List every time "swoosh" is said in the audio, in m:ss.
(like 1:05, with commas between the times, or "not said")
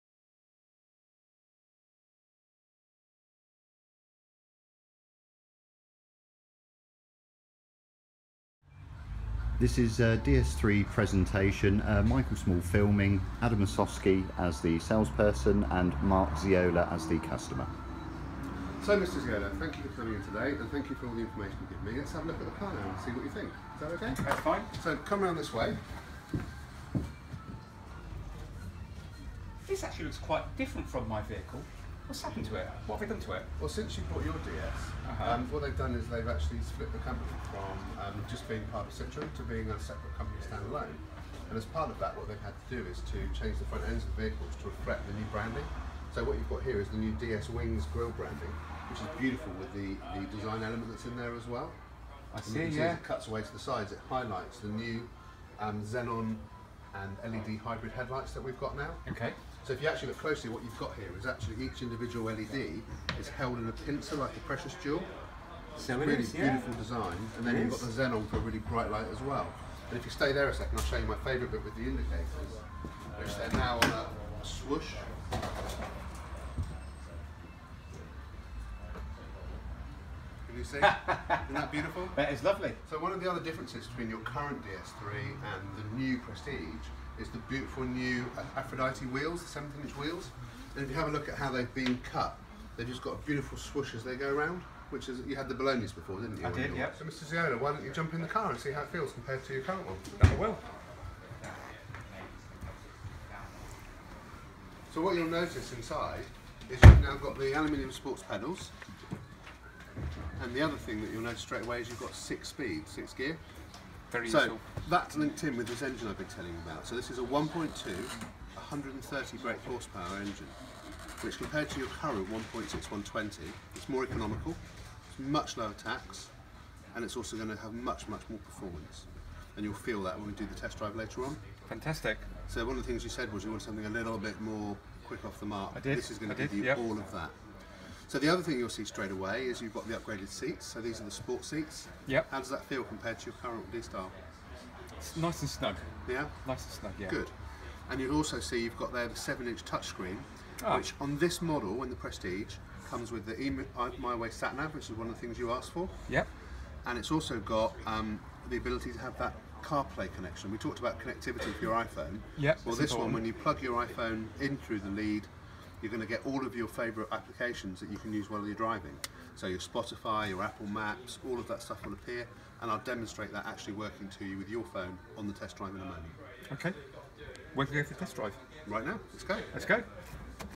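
1:14, 1:33.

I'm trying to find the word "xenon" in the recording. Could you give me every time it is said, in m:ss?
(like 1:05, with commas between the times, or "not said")
0:55, 1:08.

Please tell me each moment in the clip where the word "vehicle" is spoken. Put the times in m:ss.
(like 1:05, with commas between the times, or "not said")
0:31, 0:44.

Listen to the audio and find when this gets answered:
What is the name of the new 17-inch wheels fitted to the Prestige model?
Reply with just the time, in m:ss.
1:28.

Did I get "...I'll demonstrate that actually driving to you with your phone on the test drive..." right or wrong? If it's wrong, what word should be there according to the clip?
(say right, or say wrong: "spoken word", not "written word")
wrong: "working", not "driving".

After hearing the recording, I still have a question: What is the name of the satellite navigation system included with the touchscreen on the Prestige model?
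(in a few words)
My Way.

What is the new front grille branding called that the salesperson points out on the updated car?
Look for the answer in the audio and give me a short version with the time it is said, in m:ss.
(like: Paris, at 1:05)
DS Wings, at 0:47.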